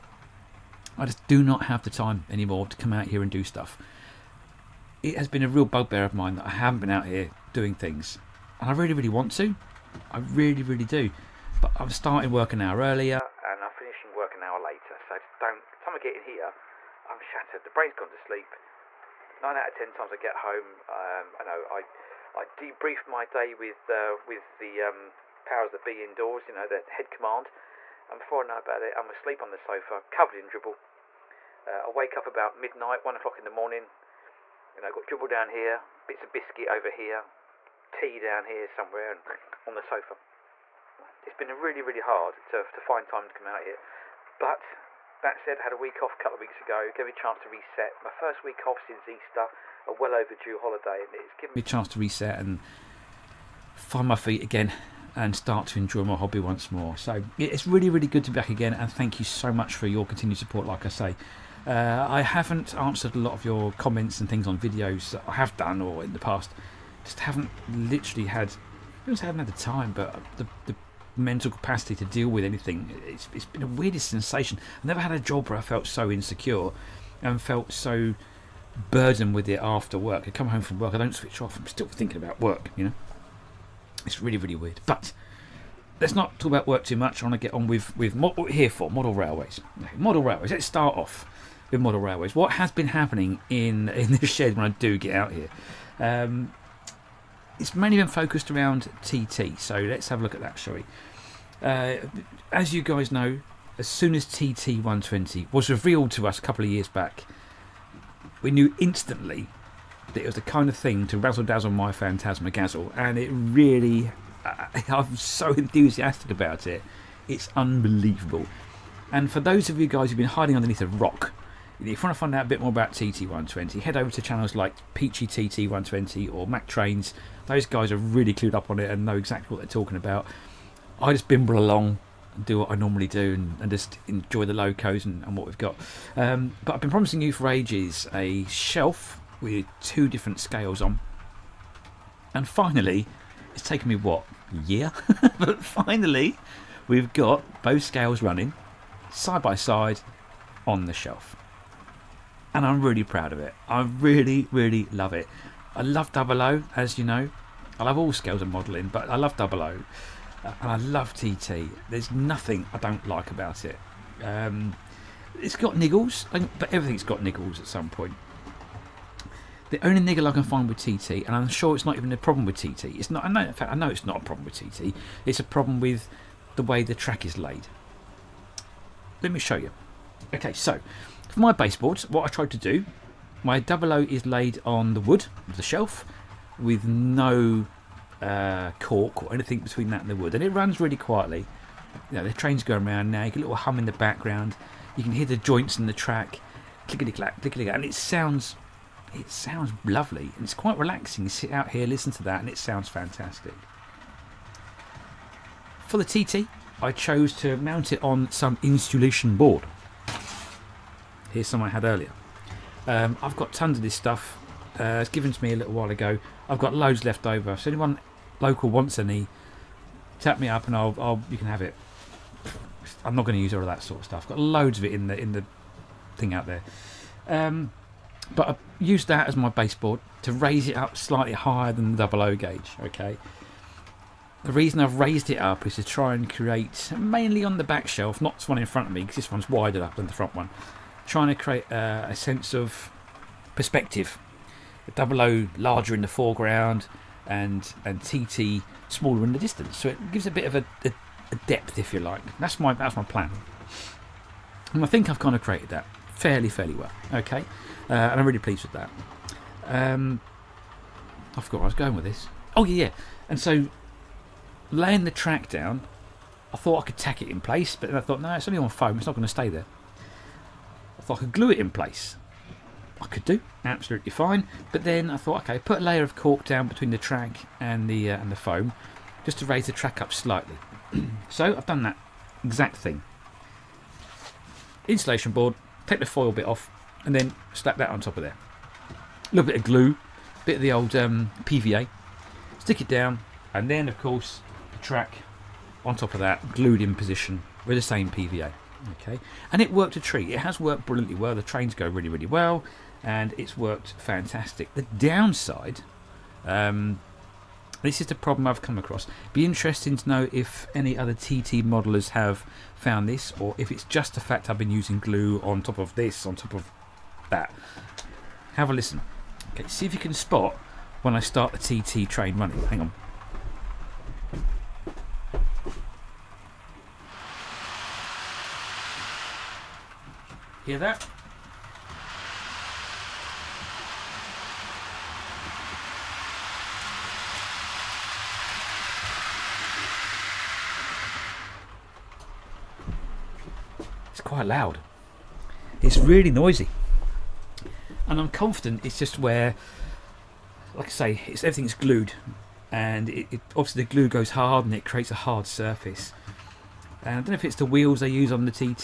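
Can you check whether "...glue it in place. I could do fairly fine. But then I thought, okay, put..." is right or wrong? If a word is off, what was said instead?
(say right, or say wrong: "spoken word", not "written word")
wrong: "absolutely", not "fairly".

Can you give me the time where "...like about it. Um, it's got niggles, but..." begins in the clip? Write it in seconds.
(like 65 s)
163 s.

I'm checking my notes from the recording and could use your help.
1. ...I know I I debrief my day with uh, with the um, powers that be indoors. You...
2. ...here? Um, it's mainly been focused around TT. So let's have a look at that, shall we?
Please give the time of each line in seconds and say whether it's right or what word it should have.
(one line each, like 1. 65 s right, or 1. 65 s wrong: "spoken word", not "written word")
1. 21 s right
2. 95 s right.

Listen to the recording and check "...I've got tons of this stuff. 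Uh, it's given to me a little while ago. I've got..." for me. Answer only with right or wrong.
right.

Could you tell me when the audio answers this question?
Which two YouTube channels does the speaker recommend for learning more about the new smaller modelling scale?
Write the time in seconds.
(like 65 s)
124 s.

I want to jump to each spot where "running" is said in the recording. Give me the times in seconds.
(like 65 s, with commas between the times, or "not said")
148 s, 322 s.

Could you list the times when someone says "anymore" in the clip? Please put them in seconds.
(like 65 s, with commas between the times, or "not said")
2 s.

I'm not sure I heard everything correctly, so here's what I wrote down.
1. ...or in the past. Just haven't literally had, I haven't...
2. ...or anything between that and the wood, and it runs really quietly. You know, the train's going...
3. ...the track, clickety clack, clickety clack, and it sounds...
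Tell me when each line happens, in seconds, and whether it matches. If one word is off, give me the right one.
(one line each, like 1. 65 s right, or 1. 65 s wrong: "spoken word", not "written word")
1. 65 s right
2. 189 s right
3. 195 s right.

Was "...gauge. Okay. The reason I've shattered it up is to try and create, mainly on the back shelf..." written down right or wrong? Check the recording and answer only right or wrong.
wrong.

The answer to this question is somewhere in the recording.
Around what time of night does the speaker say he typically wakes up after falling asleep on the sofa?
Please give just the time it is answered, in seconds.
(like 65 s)
32 s.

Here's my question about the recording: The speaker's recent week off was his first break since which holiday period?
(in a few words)
Easter.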